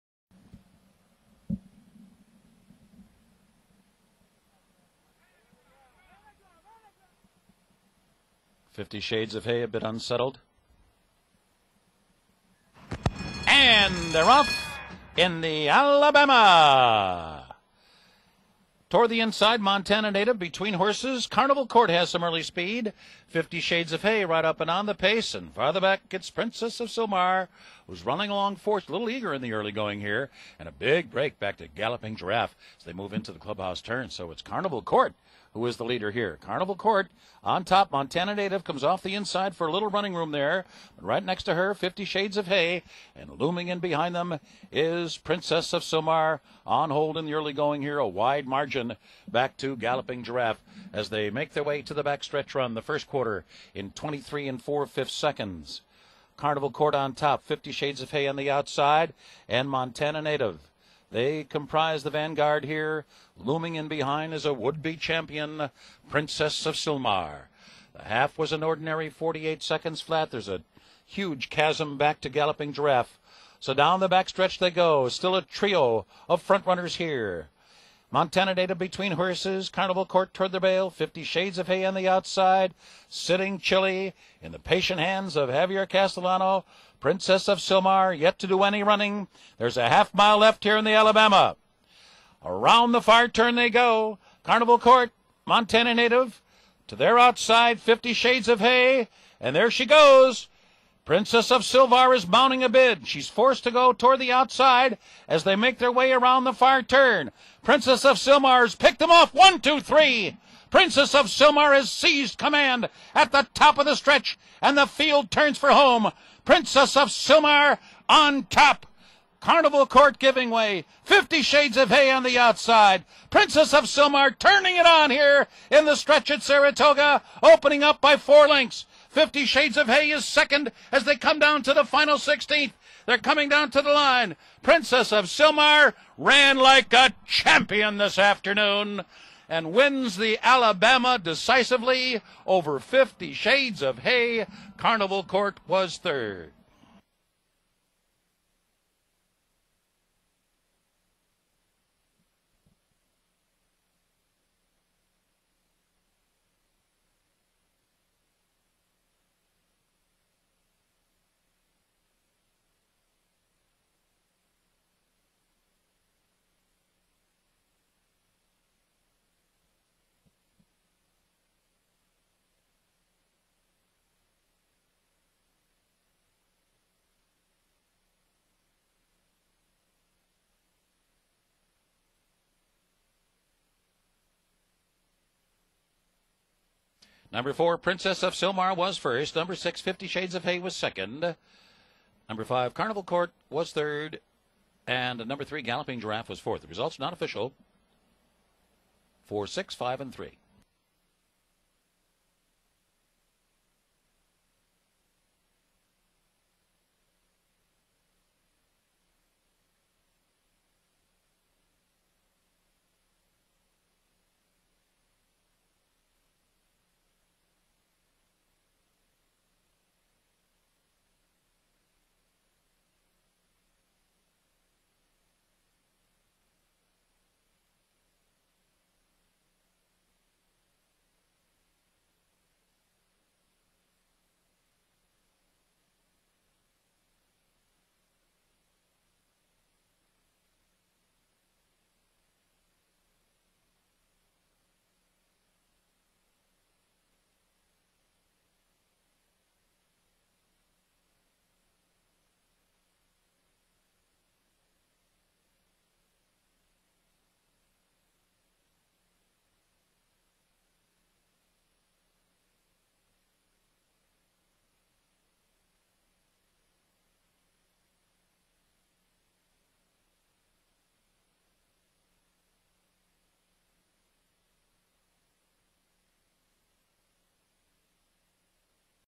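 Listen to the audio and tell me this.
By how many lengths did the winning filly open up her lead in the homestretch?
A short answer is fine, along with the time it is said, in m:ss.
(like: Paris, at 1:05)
4, at 2:08.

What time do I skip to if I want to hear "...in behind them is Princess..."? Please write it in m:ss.
0:43.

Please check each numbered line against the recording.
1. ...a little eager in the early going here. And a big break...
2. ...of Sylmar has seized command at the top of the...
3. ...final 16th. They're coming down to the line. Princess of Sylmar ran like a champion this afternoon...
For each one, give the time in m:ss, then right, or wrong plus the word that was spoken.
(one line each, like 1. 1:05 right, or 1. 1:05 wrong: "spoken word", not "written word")
1. 0:28 right
2. 1:51 right
3. 2:11 right.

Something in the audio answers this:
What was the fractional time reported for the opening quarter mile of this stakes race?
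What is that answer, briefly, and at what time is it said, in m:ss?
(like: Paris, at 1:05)
23 4/5 seconds, at 0:53.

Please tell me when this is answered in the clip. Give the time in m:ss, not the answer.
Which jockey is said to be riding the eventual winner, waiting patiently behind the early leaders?
1:25.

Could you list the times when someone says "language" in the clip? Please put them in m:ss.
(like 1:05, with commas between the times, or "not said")
not said.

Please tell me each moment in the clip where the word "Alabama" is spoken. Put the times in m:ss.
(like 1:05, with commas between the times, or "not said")
0:15, 1:30, 2:20.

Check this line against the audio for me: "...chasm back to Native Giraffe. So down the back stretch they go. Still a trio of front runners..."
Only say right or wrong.
wrong.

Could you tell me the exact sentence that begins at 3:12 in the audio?
Number five, Carnival Court was third.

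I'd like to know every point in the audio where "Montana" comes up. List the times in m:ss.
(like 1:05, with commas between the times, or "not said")
0:19, 0:37, 0:59, 1:18, 1:35.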